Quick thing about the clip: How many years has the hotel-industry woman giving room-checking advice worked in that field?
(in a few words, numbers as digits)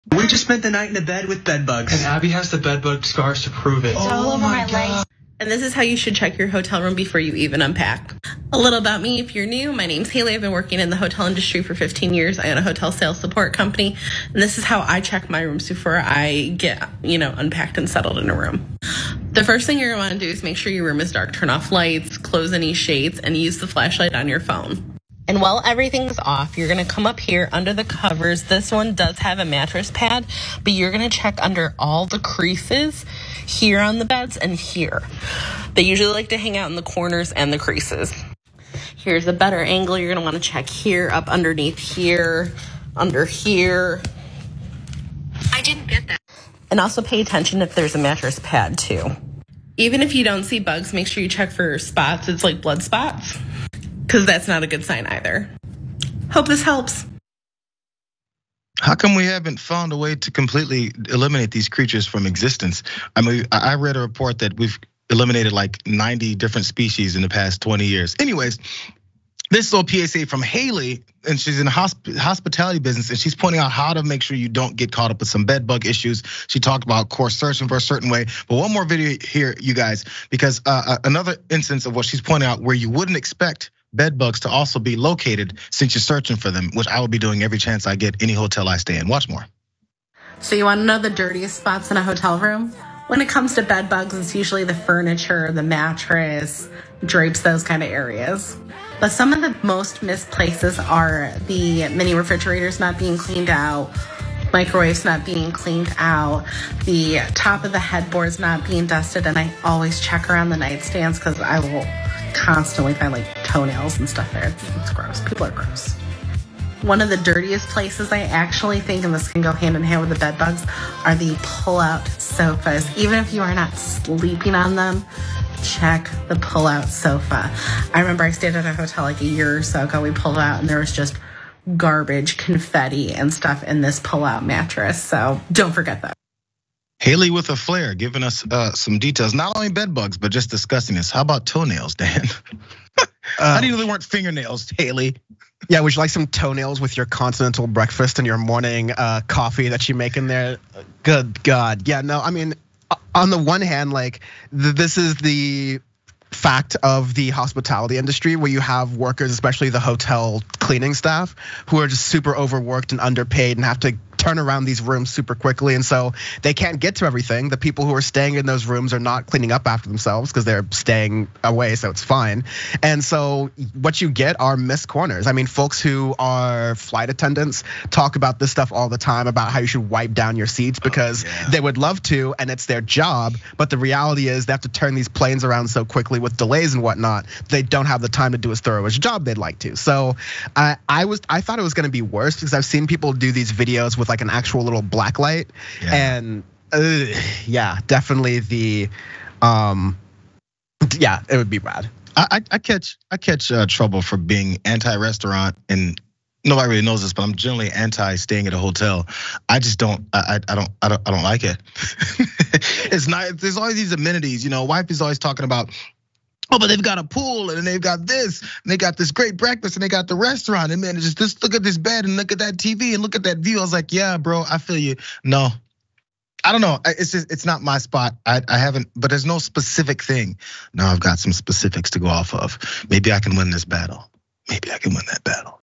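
15.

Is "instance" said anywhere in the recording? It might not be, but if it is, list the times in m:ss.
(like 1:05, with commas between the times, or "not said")
1:21.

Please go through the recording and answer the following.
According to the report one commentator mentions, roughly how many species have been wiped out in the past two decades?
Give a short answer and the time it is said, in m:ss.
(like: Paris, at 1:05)
90, at 1:05.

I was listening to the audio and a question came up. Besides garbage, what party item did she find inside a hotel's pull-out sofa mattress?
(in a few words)
Confetti.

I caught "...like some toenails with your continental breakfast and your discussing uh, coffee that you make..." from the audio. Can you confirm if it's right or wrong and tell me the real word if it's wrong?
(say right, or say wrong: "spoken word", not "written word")
wrong: "morning", not "discussing".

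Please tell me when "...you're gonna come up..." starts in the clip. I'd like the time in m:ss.
0:26.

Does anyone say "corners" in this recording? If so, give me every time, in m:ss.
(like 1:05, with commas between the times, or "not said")
0:36, 2:54.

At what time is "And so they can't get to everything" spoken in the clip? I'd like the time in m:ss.
2:45.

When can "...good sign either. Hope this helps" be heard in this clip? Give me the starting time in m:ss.
0:54.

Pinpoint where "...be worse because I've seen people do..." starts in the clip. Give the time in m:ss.
3:11.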